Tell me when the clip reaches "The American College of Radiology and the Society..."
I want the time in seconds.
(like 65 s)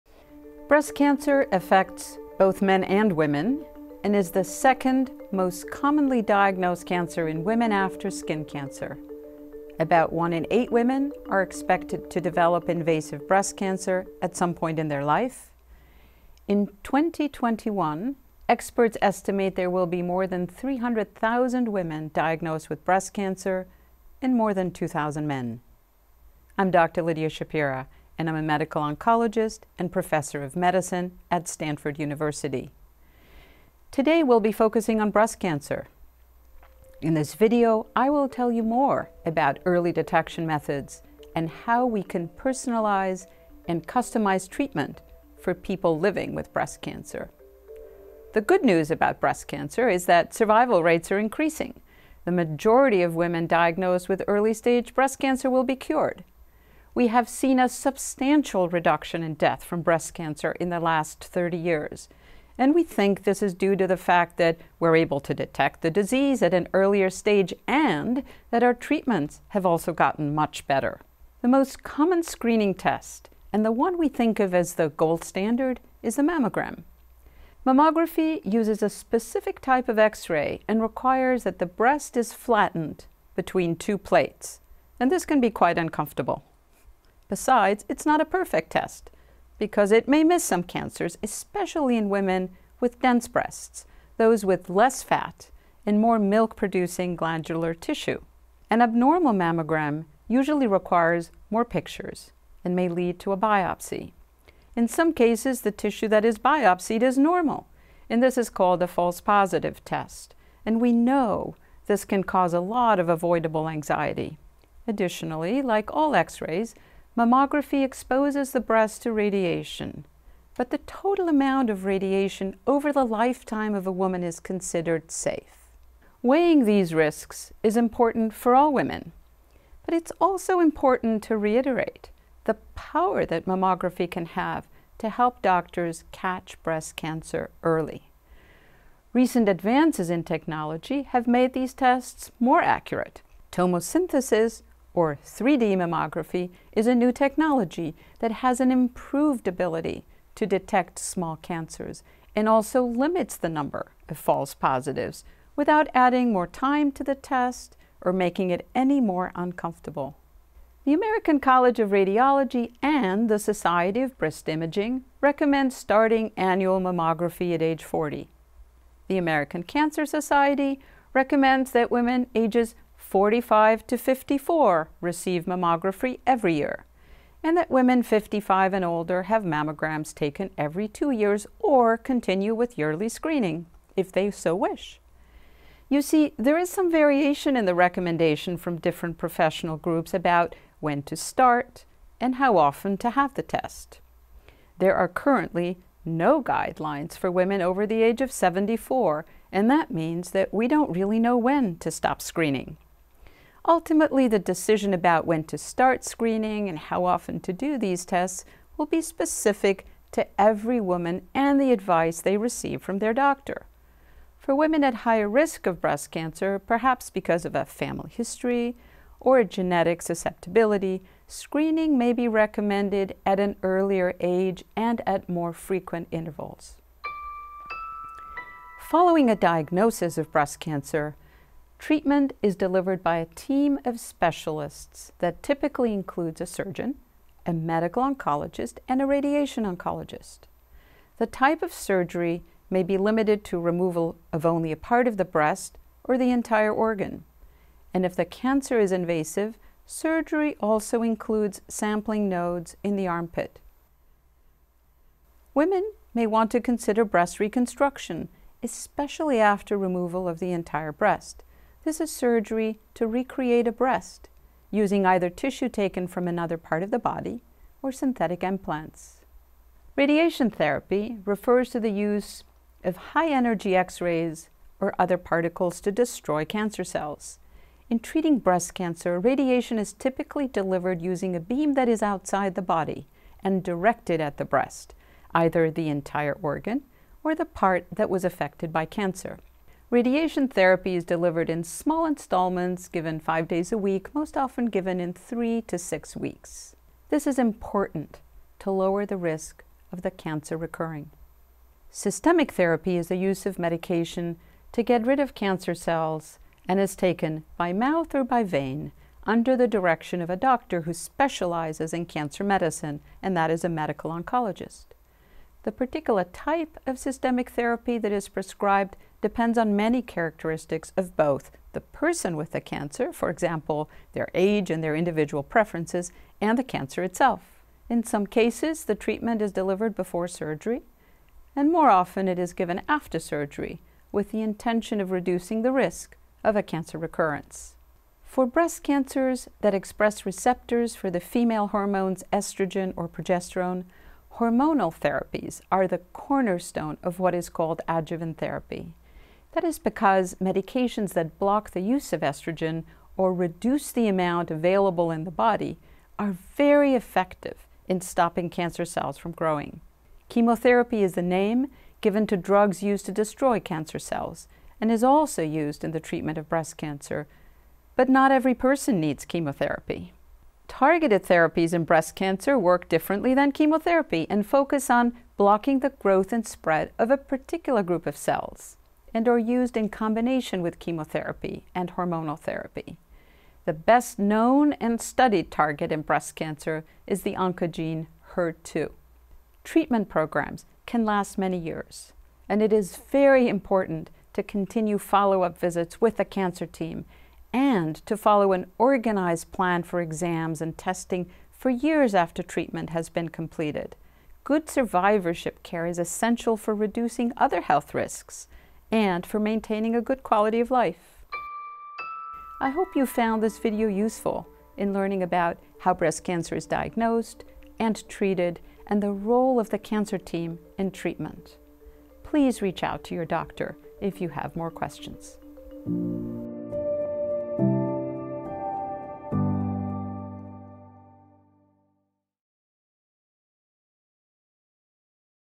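160 s.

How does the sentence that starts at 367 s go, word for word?
But not every person needs chemotherapy.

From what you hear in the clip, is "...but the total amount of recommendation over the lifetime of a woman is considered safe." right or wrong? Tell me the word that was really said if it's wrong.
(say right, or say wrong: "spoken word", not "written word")
wrong: "radiation", not "recommendation".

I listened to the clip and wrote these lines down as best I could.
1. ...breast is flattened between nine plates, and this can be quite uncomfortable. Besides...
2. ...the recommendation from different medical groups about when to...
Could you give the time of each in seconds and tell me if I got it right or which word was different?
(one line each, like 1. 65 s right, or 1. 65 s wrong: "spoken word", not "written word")
1. 81 s wrong: "two", not "nine"
2. 187 s wrong: "professional", not "medical".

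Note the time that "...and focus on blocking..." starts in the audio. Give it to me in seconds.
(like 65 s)
374 s.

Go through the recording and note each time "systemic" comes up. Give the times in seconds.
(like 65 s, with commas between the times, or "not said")
301 s, 316 s.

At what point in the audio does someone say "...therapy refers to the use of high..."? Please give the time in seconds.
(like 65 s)
270 s.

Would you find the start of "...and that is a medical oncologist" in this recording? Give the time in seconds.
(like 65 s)
313 s.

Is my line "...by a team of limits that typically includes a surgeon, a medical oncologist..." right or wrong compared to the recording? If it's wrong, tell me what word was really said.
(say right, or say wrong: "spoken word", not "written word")
wrong: "specialists", not "limits".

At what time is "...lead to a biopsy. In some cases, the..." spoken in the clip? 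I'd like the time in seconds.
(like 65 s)
102 s.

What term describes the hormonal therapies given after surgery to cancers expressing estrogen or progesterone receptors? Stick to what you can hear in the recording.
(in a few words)
adjuvant therapy.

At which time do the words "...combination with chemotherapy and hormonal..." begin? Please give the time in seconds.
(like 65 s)
379 s.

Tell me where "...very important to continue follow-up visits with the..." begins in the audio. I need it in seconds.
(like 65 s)
393 s.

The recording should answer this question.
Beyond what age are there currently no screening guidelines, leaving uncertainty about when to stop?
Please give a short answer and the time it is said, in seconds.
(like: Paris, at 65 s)
74, at 198 s.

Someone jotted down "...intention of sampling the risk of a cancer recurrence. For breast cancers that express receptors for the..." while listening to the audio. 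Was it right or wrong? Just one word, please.
wrong.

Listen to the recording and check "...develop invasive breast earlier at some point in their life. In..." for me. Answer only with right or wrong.
wrong.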